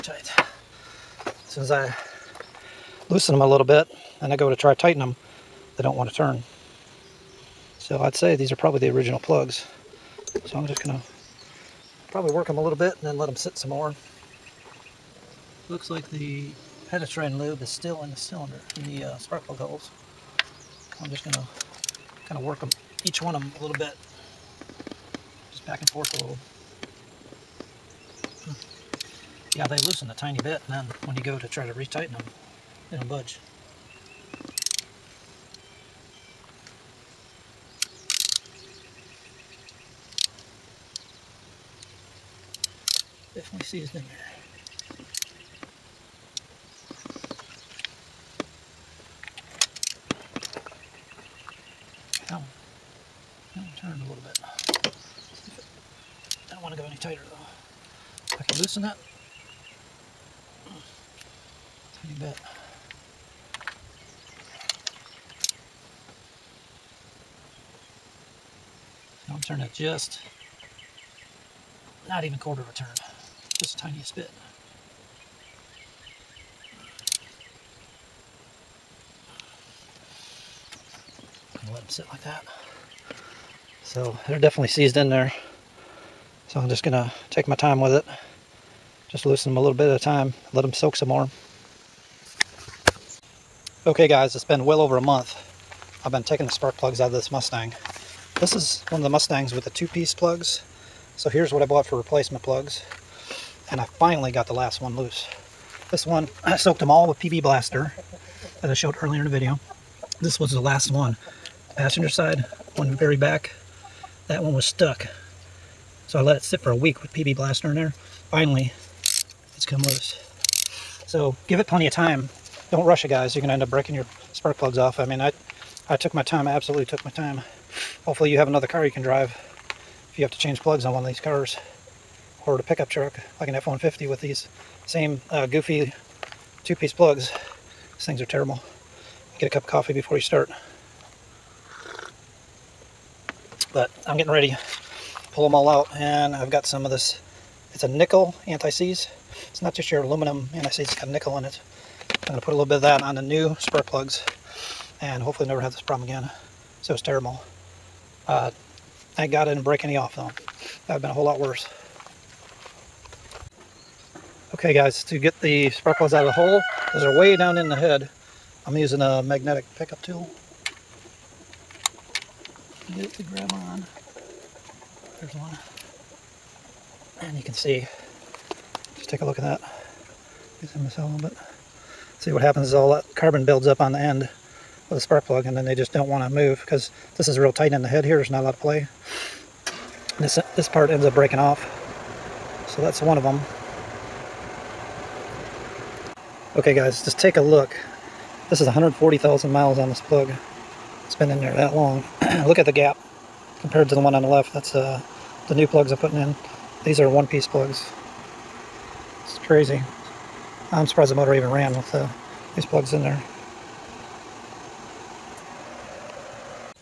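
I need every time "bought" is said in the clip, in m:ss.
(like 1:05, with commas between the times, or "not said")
1:41.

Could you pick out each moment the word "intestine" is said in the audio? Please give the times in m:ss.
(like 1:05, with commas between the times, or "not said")
not said.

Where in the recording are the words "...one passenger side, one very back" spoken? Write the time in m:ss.
1:50.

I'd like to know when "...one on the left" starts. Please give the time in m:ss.
3:23.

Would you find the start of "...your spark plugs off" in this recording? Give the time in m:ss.
2:03.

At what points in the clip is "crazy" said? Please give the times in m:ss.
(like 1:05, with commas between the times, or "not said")
3:29.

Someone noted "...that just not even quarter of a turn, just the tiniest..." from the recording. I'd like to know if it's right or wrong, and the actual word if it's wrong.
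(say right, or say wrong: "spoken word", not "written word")
right.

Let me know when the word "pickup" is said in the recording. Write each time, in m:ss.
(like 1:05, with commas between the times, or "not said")
2:12, 2:49.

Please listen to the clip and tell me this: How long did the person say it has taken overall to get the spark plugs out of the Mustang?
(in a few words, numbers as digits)
Over a month.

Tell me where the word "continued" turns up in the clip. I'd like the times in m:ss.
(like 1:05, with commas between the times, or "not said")
not said.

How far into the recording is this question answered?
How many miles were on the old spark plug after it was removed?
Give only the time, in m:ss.
3:18.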